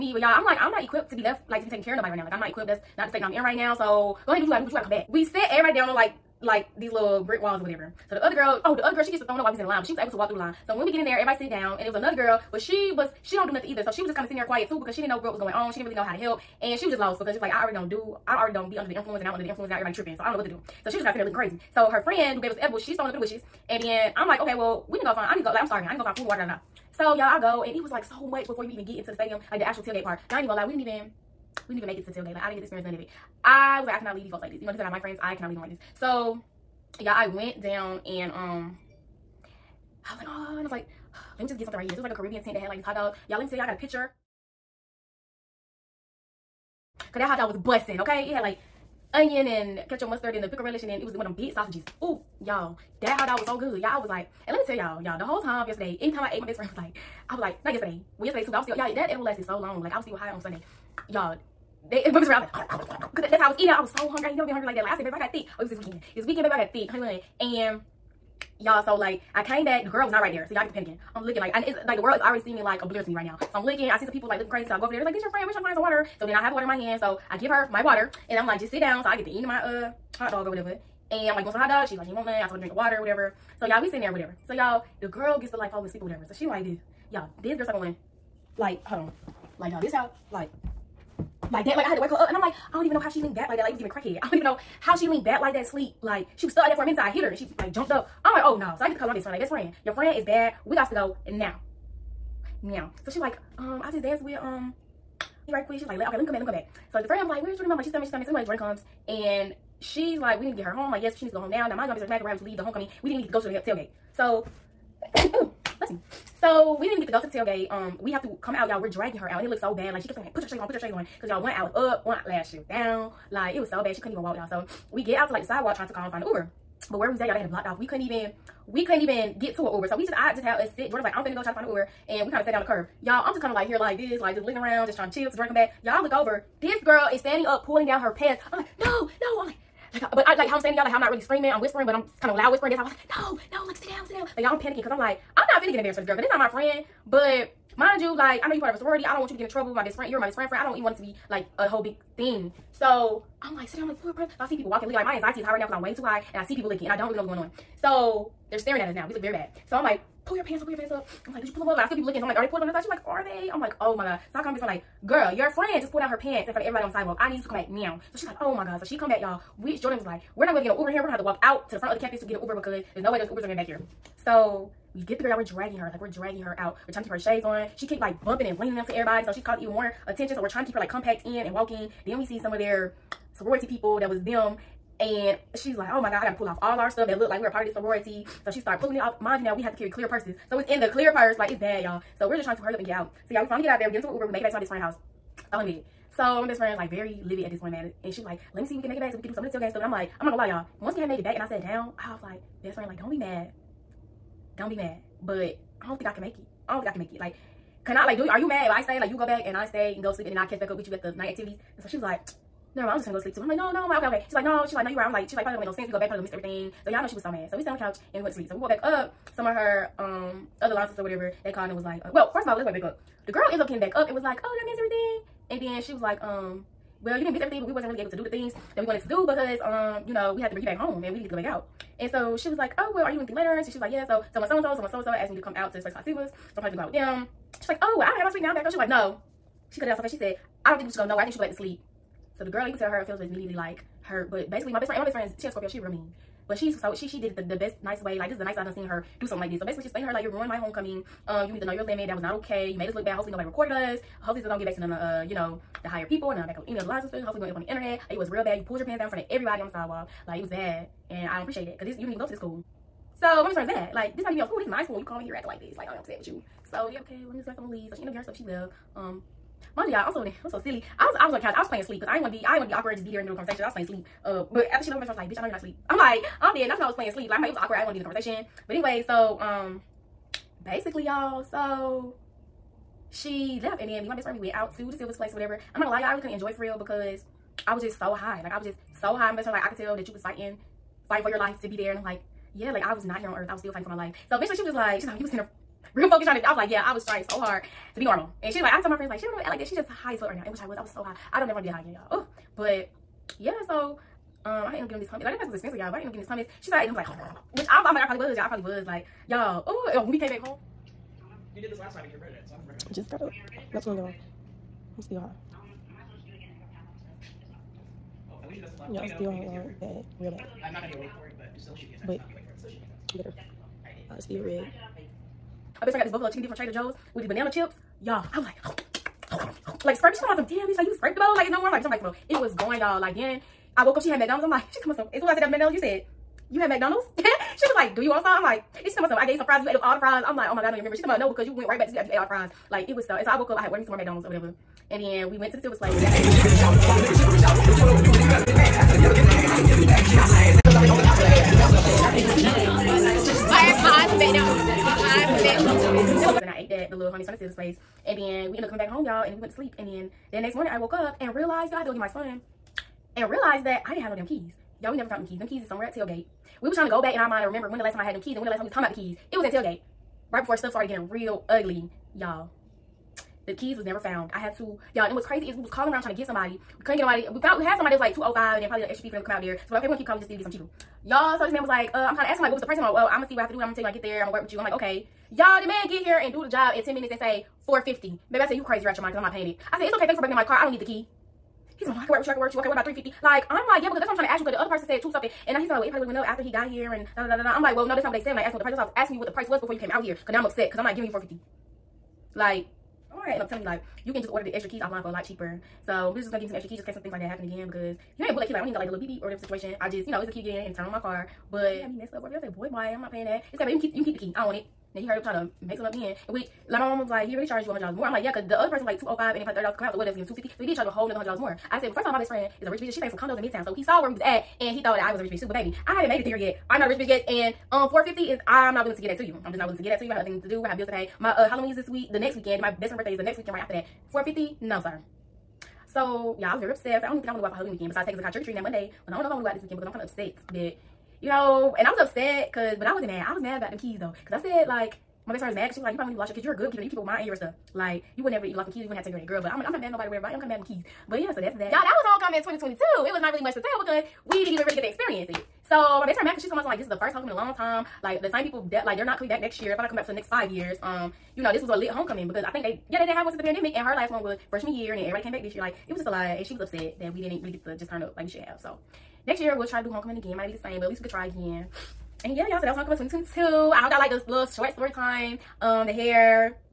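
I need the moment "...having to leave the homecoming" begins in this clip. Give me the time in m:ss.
1:52.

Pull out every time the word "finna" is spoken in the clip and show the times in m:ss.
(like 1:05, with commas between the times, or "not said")
2:11, 2:25.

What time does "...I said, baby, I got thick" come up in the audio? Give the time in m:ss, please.
1:04.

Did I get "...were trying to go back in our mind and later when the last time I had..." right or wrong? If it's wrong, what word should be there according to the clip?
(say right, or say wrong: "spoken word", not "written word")
wrong: "remember", not "later".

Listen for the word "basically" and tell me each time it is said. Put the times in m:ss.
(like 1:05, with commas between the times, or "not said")
4:04, 4:09, 4:40.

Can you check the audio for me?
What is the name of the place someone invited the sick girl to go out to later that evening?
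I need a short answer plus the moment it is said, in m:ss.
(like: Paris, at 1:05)
Sivas, at 3:56.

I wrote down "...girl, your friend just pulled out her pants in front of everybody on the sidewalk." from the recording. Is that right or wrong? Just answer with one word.
right.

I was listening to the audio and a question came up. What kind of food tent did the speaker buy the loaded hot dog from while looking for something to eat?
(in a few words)
Caribbean.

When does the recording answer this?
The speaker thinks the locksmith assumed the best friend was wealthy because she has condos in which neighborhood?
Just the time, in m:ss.
7:03.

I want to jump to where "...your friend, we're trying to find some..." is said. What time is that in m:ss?
1:15.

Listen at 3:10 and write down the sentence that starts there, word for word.
So it's in the clear purse.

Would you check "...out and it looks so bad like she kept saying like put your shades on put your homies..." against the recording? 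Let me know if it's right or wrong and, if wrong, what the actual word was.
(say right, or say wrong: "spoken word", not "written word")
wrong: "shades", not "homies".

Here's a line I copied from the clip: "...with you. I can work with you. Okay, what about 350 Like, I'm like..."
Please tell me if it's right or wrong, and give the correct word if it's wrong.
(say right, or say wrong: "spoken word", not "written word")
right.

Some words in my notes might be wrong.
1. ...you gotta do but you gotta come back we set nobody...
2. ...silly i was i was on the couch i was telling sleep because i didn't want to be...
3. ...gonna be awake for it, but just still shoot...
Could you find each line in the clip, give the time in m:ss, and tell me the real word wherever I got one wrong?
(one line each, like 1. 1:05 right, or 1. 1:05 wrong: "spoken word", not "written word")
1. 0:04 wrong: "everybody", not "nobody"
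2. 4:30 wrong: "playing", not "telling"
3. 5:20 right.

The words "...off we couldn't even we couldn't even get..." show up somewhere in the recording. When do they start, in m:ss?
2:07.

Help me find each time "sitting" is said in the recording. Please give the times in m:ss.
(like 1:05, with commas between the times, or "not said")
0:14, 0:21, 1:23, 2:33.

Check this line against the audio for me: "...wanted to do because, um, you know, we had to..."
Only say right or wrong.
right.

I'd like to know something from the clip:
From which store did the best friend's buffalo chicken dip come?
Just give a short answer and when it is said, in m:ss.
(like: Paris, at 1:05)
Trader Joe's, at 5:26.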